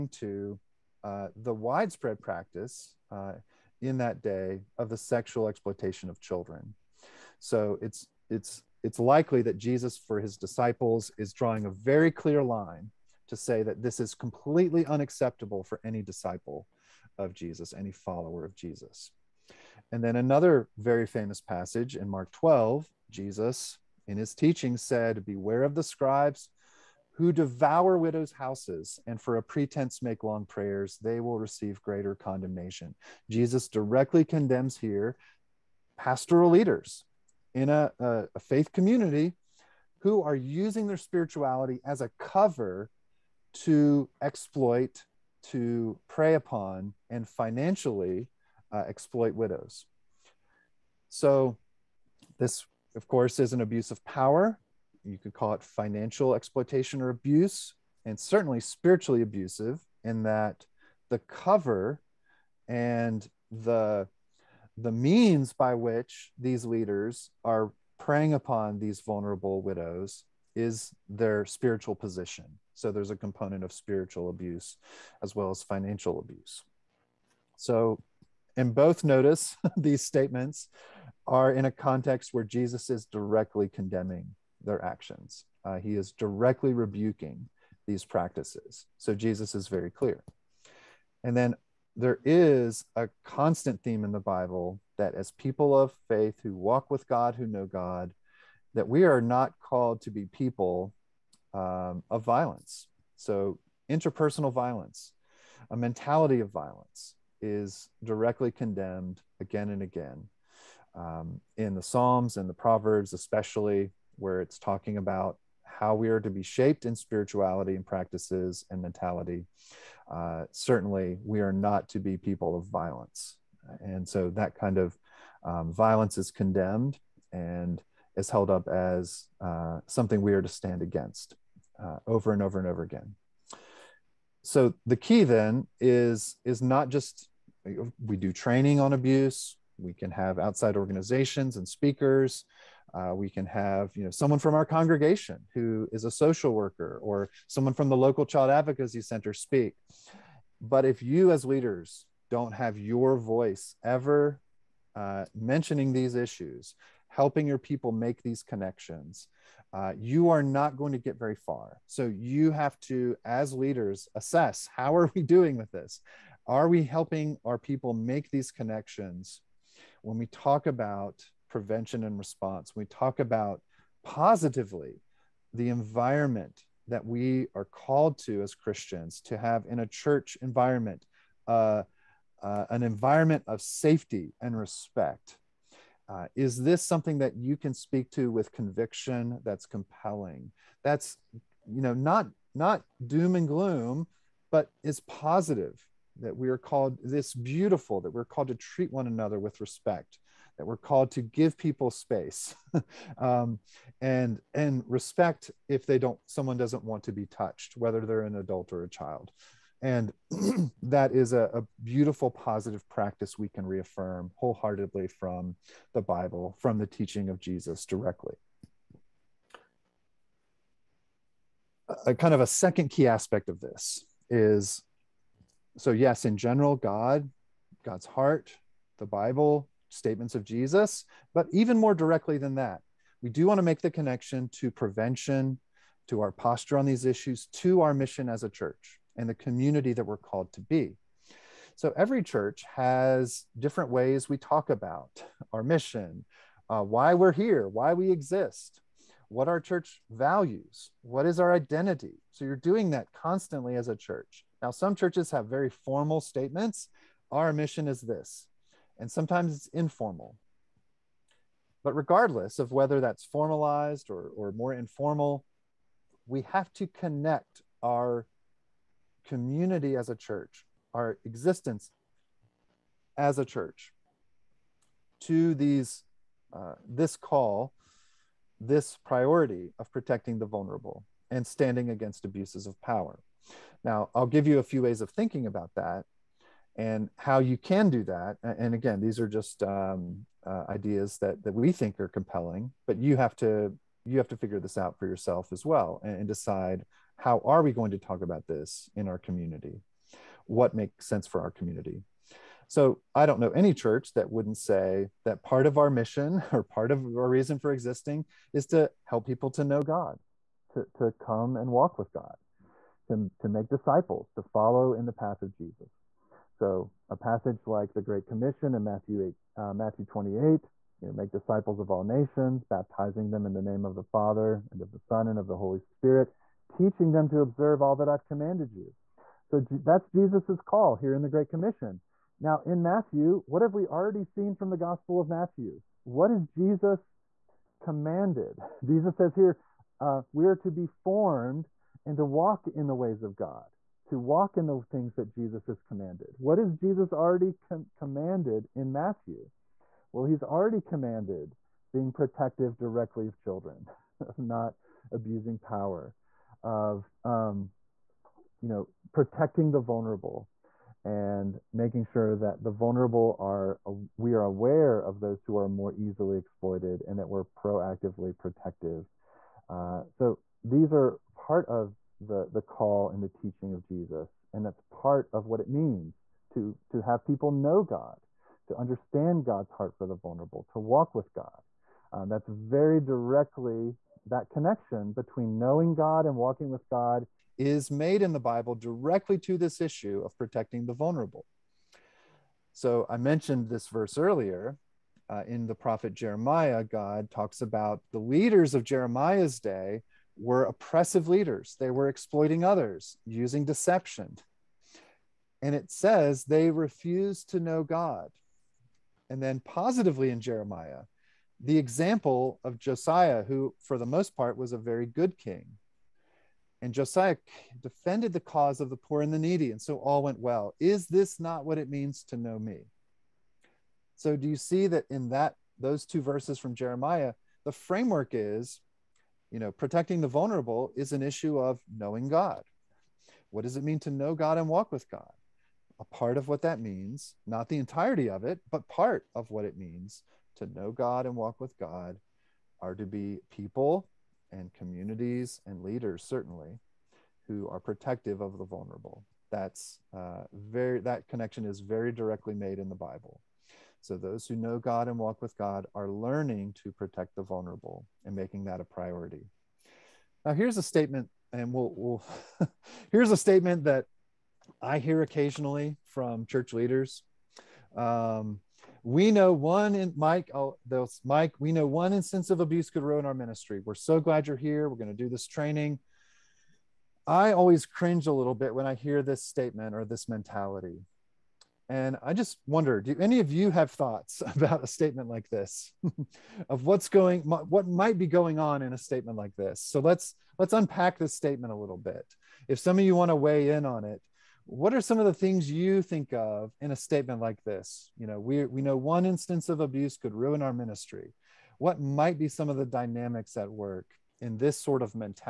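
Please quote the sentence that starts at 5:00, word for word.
What makes sense for our community?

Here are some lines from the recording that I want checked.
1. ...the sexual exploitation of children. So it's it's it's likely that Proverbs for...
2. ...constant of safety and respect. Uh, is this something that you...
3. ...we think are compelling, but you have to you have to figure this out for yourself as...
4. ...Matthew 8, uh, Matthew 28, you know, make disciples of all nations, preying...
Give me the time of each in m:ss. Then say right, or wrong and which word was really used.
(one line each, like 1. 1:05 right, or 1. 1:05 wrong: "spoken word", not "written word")
1. 0:04 wrong: "Jesus", not "Proverbs"
2. 3:02 wrong: "environment", not "constant"
3. 4:51 right
4. 5:18 wrong: "baptizing", not "preying".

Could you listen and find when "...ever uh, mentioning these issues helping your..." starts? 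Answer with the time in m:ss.
2:33.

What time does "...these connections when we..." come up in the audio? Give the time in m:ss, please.
2:48.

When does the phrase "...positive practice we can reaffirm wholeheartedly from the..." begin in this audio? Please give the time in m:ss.
3:32.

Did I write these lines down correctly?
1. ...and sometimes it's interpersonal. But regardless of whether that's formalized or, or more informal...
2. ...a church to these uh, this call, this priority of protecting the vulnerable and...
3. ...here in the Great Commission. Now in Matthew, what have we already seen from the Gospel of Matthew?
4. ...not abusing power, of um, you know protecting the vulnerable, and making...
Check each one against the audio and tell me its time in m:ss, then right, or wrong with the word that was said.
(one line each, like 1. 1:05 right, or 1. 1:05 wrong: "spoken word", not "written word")
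1. 4:18 wrong: "informal", not "interpersonal"
2. 4:33 right
3. 5:30 right
4. 5:54 right.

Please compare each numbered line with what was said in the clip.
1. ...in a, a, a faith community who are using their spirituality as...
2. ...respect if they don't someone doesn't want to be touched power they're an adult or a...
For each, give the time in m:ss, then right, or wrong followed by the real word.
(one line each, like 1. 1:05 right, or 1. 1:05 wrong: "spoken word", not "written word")
1. 0:37 right
2. 3:24 wrong: "whether", not "power".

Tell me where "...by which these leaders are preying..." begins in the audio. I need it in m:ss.
1:05.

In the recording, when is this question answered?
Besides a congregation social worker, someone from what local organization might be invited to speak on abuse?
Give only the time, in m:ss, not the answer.
2:27.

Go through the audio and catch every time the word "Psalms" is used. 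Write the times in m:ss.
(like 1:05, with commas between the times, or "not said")
1:51.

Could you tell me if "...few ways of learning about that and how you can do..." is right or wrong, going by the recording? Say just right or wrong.
wrong.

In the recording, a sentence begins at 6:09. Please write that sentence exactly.
Uh, so these are part of the, the call and the teaching of Jesus.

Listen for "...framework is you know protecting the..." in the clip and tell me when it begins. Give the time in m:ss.
7:07.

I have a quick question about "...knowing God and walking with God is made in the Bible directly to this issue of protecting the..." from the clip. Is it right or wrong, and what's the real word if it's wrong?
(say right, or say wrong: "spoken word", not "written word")
right.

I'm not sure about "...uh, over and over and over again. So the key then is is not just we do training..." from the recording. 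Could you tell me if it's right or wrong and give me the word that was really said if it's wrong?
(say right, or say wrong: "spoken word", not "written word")
right.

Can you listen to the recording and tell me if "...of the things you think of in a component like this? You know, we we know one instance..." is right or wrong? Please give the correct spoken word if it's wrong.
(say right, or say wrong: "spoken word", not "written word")
wrong: "statement", not "component".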